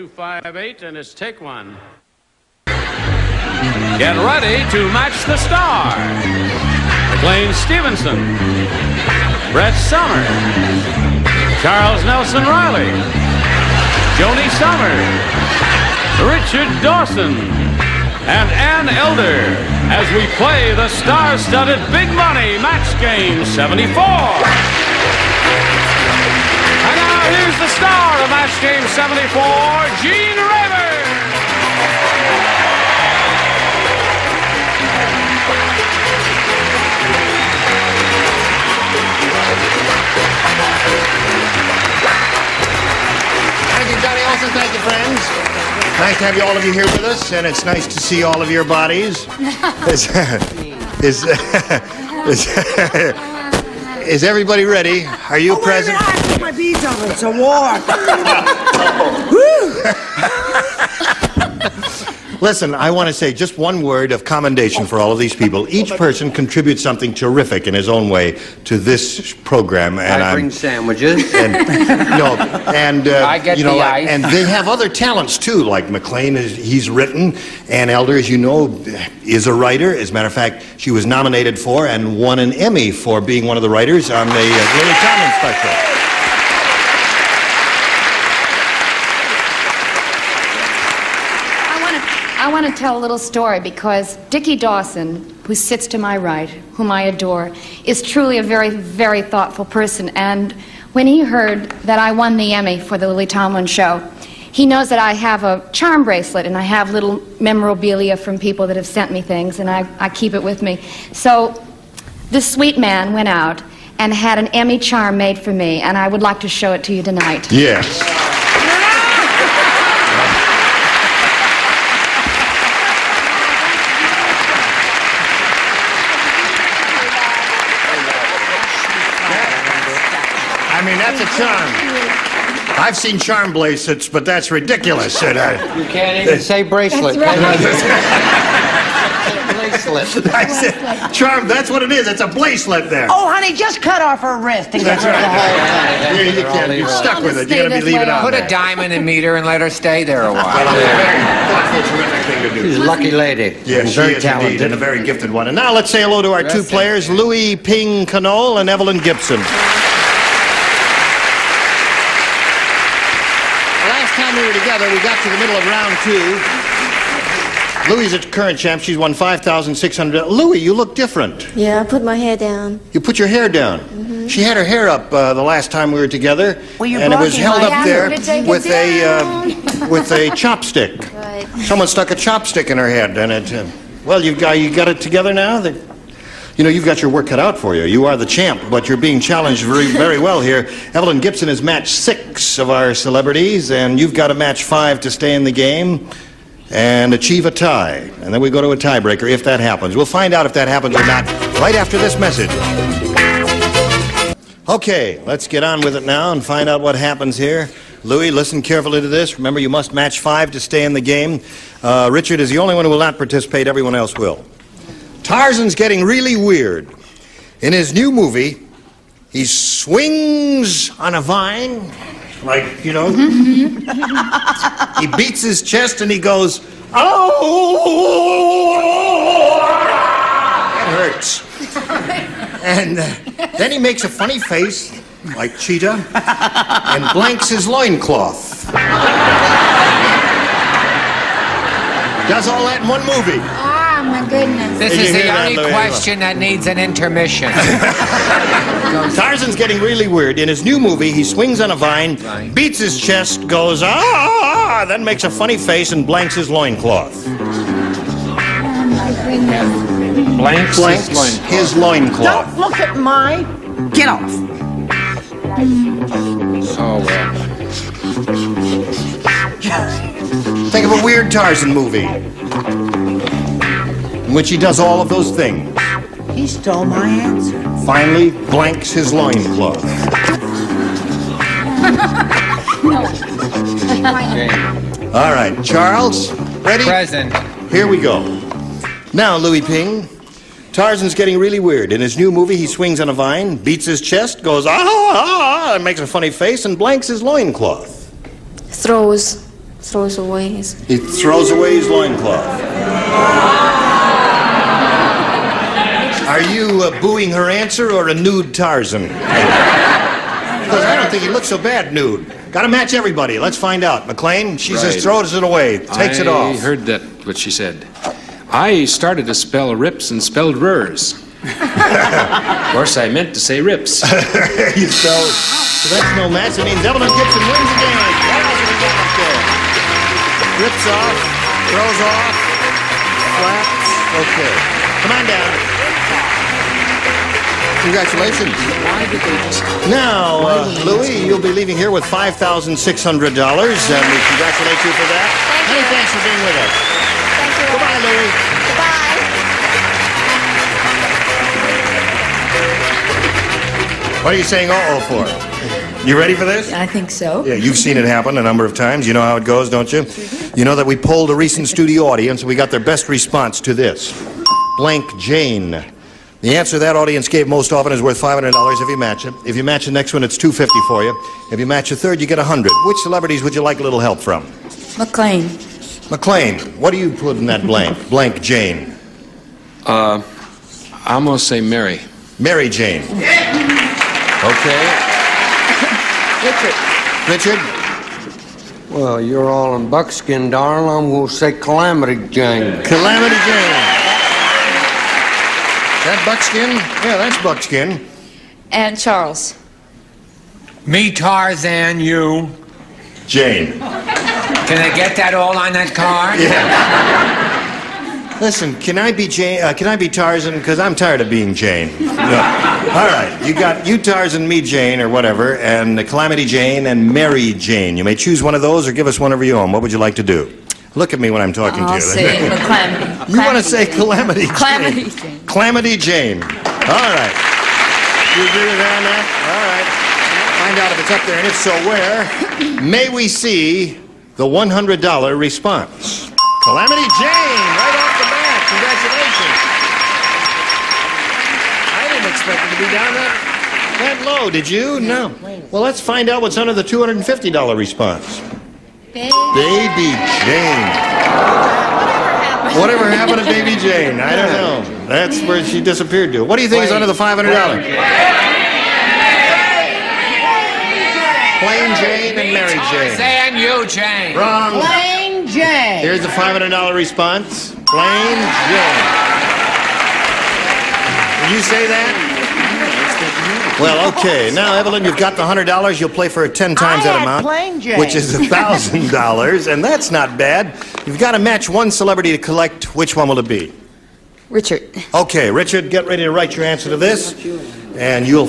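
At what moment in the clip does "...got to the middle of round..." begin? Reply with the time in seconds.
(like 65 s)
164 s.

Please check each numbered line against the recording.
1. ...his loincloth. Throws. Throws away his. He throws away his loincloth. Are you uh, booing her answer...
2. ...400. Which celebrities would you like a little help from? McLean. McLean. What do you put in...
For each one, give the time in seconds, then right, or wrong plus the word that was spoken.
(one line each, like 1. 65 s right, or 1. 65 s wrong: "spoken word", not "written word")
1. 297 s right
2. 372 s wrong: "100", not "400".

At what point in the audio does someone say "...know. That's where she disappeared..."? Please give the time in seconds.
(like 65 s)
454 s.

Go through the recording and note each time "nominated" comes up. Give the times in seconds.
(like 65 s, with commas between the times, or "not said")
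81 s.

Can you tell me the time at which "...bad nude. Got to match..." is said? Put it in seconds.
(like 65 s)
311 s.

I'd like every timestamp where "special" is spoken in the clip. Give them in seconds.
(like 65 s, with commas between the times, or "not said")
85 s.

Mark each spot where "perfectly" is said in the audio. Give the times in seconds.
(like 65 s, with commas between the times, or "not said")
not said.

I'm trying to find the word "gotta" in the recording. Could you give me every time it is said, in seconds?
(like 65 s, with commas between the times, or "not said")
147 s.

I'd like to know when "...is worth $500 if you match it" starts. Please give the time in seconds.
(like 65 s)
367 s.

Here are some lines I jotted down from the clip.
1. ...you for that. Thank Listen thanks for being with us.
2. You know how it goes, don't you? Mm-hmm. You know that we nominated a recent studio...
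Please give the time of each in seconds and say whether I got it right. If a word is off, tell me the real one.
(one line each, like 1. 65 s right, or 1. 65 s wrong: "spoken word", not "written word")
1. 343 s wrong: "Many", not "Listen"
2. 359 s wrong: "polled", not "nominated".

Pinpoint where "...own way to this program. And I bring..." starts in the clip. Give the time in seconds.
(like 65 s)
67 s.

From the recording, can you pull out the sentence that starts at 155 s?
And now let's say hello to our two players, Louis Ping Canole and Evelyn Gibson.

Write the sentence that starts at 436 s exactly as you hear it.
Calamity Jane, right off the bat.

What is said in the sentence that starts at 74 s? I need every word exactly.
and they have other talents too.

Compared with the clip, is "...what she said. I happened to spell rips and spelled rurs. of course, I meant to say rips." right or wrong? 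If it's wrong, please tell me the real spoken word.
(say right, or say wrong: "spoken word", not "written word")
wrong: "started", not "happened".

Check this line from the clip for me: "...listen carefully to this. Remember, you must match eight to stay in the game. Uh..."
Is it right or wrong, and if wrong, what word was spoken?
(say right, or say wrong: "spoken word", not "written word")
wrong: "five", not "eight".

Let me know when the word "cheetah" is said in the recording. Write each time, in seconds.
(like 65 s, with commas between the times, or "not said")
235 s.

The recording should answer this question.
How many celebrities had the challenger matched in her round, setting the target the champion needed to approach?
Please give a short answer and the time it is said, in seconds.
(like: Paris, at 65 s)
6, at 191 s.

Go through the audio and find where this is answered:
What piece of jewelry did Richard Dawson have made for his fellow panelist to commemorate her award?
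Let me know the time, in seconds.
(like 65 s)
114 s.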